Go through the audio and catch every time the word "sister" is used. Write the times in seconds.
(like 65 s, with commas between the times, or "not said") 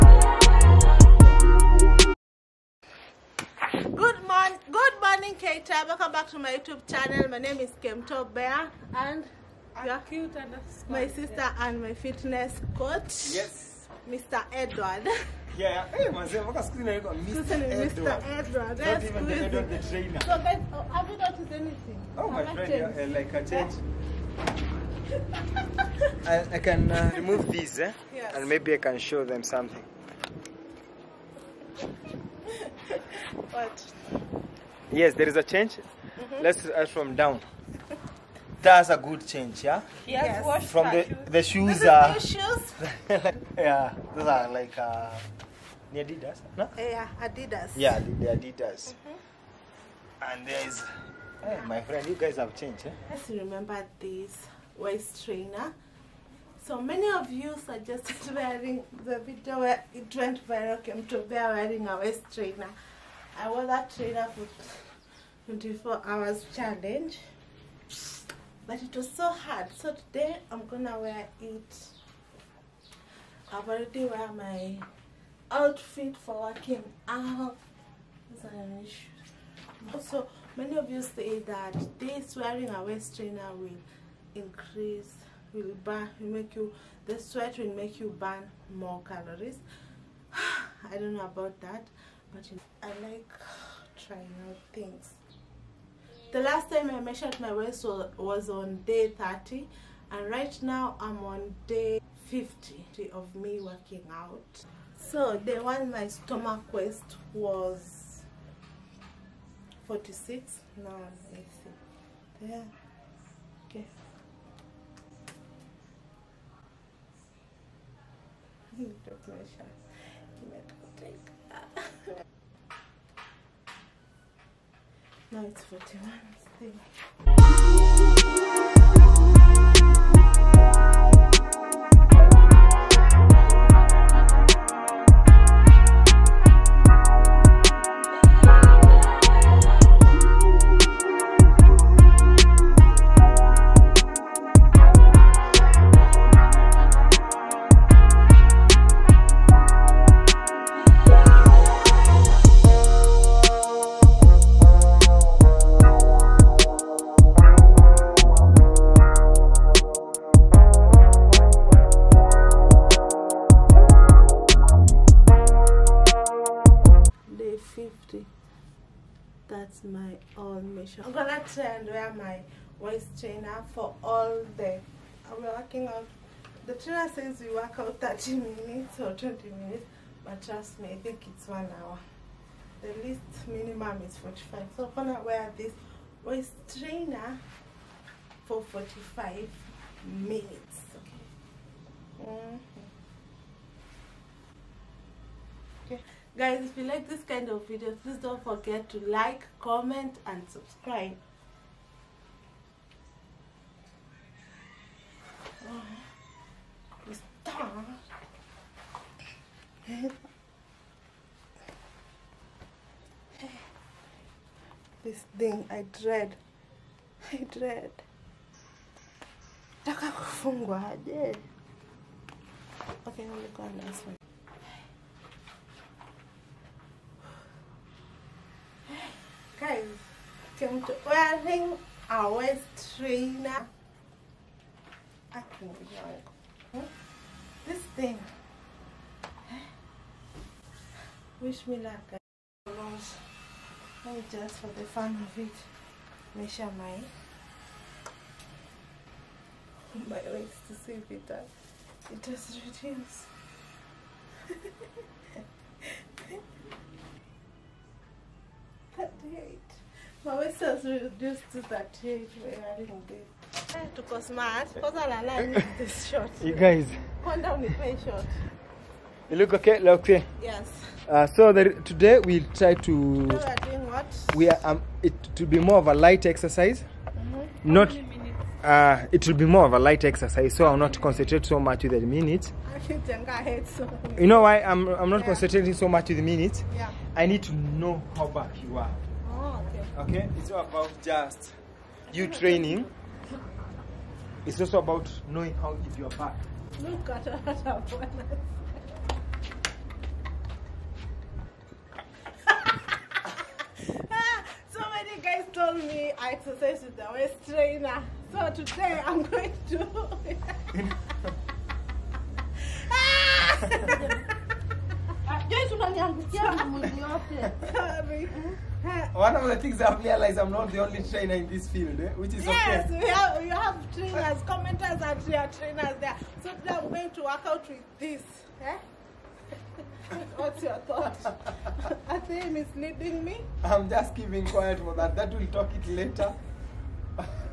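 11 s, 260 s.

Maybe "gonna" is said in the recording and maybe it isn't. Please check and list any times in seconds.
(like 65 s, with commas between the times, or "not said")
70 s, 171 s, 185 s.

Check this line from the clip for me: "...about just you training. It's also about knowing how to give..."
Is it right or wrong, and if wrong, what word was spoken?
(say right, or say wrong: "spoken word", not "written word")
right.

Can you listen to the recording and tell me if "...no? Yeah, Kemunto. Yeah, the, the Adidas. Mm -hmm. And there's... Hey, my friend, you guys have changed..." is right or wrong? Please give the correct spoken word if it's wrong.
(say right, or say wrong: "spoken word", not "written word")
wrong: "Adidas", not "Kemunto".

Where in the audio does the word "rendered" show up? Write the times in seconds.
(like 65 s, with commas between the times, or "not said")
not said.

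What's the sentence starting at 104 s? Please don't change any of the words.
So day one my stomach waist was 46.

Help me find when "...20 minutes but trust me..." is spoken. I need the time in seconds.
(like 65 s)
179 s.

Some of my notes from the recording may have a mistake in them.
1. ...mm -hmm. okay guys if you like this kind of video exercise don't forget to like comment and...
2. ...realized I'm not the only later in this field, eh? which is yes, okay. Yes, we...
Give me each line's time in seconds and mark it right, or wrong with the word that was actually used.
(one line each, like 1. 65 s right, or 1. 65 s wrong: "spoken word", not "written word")
1. 192 s wrong: "please", not "exercise"
2. 320 s wrong: "trainer", not "later".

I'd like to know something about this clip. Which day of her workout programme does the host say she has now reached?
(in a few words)
day 50.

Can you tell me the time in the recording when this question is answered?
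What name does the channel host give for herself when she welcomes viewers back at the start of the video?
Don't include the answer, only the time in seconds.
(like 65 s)
7 s.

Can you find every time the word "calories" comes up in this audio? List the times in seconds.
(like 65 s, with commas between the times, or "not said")
89 s.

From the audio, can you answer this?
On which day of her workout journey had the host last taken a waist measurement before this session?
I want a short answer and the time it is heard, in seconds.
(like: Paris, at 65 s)
day 30, at 98 s.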